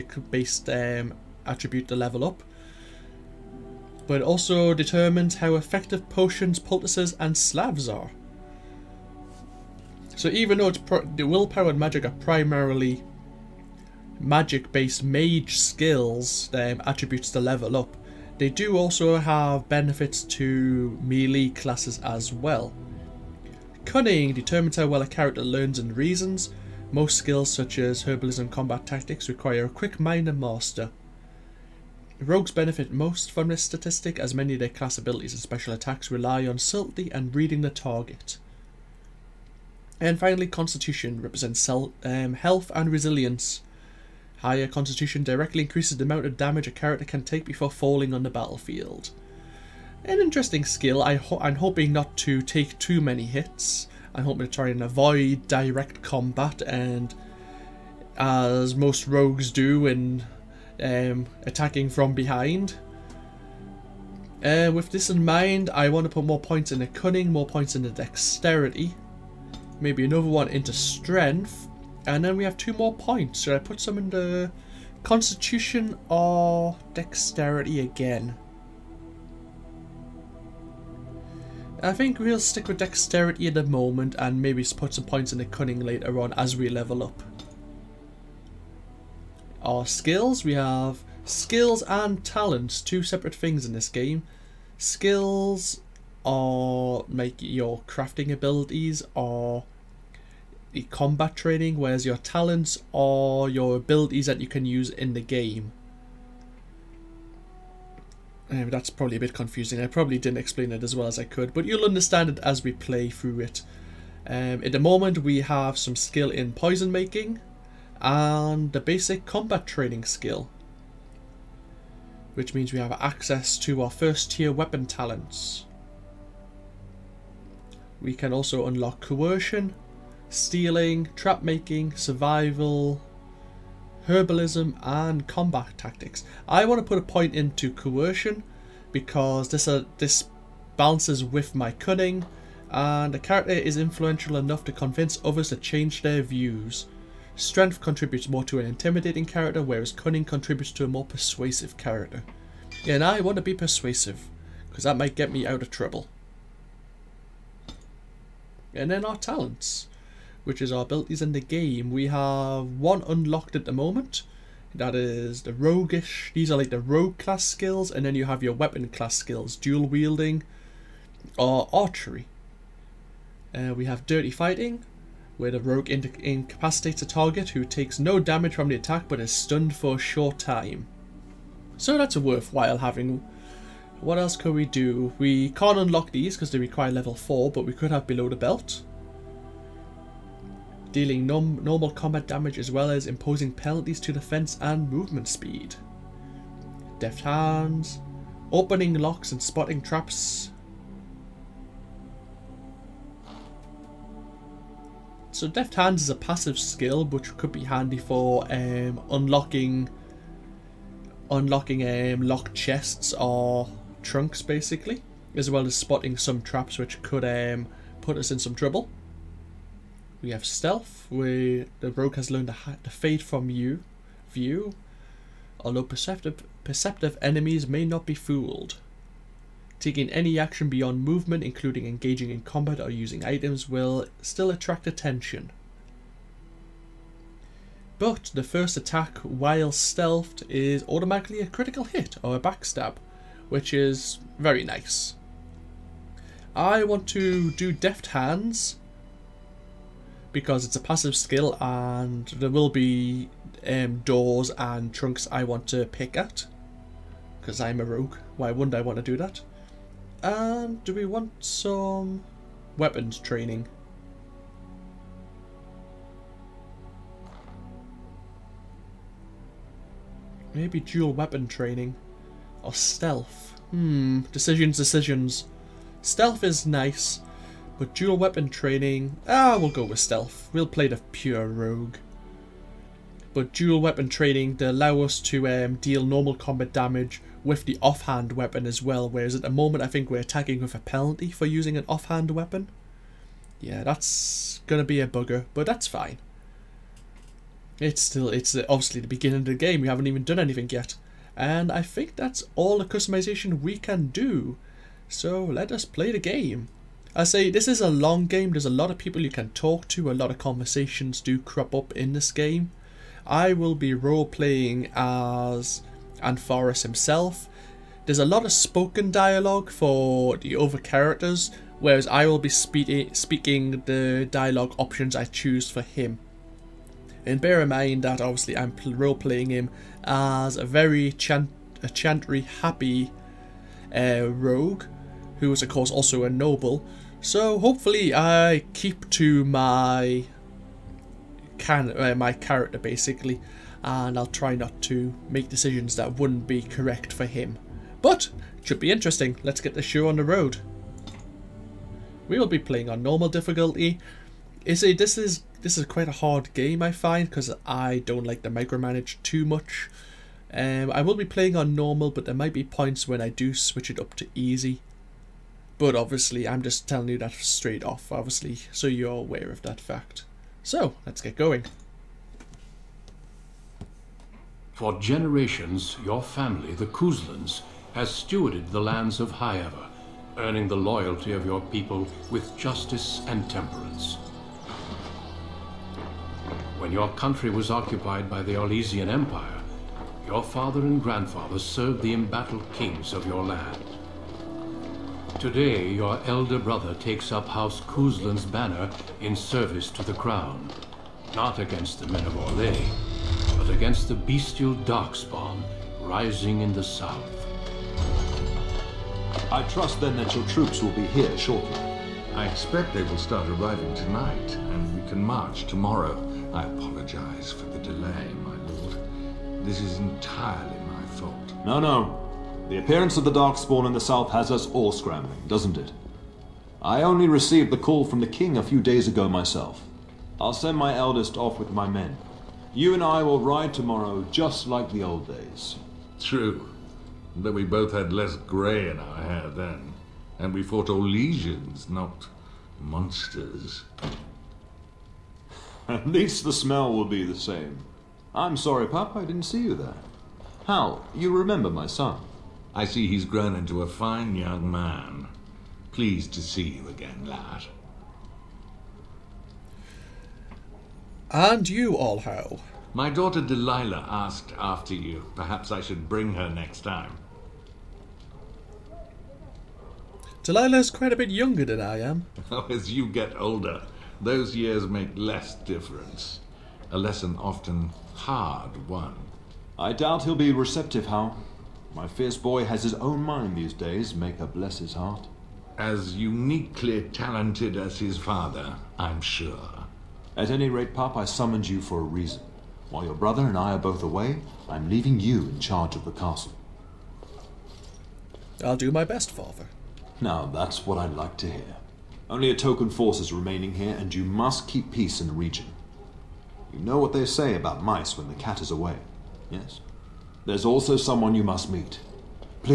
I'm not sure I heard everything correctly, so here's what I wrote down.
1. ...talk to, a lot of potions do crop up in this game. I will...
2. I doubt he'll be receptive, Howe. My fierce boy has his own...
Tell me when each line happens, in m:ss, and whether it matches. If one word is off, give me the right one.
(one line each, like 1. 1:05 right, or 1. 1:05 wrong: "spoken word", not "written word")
1. 5:09 wrong: "conversations", not "potions"
2. 7:59 right.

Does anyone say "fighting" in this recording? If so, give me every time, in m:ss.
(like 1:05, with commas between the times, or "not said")
2:54.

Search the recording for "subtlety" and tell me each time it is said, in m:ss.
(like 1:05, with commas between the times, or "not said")
0:36.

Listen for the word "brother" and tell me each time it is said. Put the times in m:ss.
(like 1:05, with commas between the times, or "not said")
6:36, 8:13.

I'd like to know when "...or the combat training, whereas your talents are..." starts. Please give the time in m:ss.
1:39.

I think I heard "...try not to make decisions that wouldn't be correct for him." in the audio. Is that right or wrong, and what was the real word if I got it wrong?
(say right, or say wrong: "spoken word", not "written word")
right.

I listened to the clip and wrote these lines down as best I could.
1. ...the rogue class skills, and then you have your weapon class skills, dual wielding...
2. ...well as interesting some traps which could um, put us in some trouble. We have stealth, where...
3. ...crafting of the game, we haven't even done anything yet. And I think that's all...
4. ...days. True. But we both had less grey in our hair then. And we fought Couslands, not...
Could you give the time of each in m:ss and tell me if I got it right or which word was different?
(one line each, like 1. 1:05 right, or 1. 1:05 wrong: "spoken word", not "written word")
1. 2:46 right
2. 3:35 wrong: "spotting", not "interesting"
3. 4:59 wrong: "beginning", not "crafting"
4. 7:15 wrong: "Orlesians", not "Couslands".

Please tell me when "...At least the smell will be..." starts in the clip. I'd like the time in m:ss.
7:25.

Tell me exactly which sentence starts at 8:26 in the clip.
You know what they say about mice when the cat is away, yes?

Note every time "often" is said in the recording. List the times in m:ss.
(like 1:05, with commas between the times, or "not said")
7:57.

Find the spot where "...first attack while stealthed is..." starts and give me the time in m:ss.
3:58.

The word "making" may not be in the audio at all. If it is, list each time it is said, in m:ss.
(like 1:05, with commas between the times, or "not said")
1:56, 2:11.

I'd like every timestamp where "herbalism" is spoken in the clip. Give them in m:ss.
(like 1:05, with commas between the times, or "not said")
0:28, 2:14.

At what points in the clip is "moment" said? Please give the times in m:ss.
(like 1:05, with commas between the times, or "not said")
1:23, 1:54, 2:43, 4:49.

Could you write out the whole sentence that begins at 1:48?
Um, that's probably a bit confusing.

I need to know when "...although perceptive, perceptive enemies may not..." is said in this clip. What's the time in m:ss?
3:45.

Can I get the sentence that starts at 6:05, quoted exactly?
But obviously, I'm just telling you that straight off, obviously, so you're aware of that fact.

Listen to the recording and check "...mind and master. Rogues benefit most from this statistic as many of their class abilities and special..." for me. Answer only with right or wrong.
right.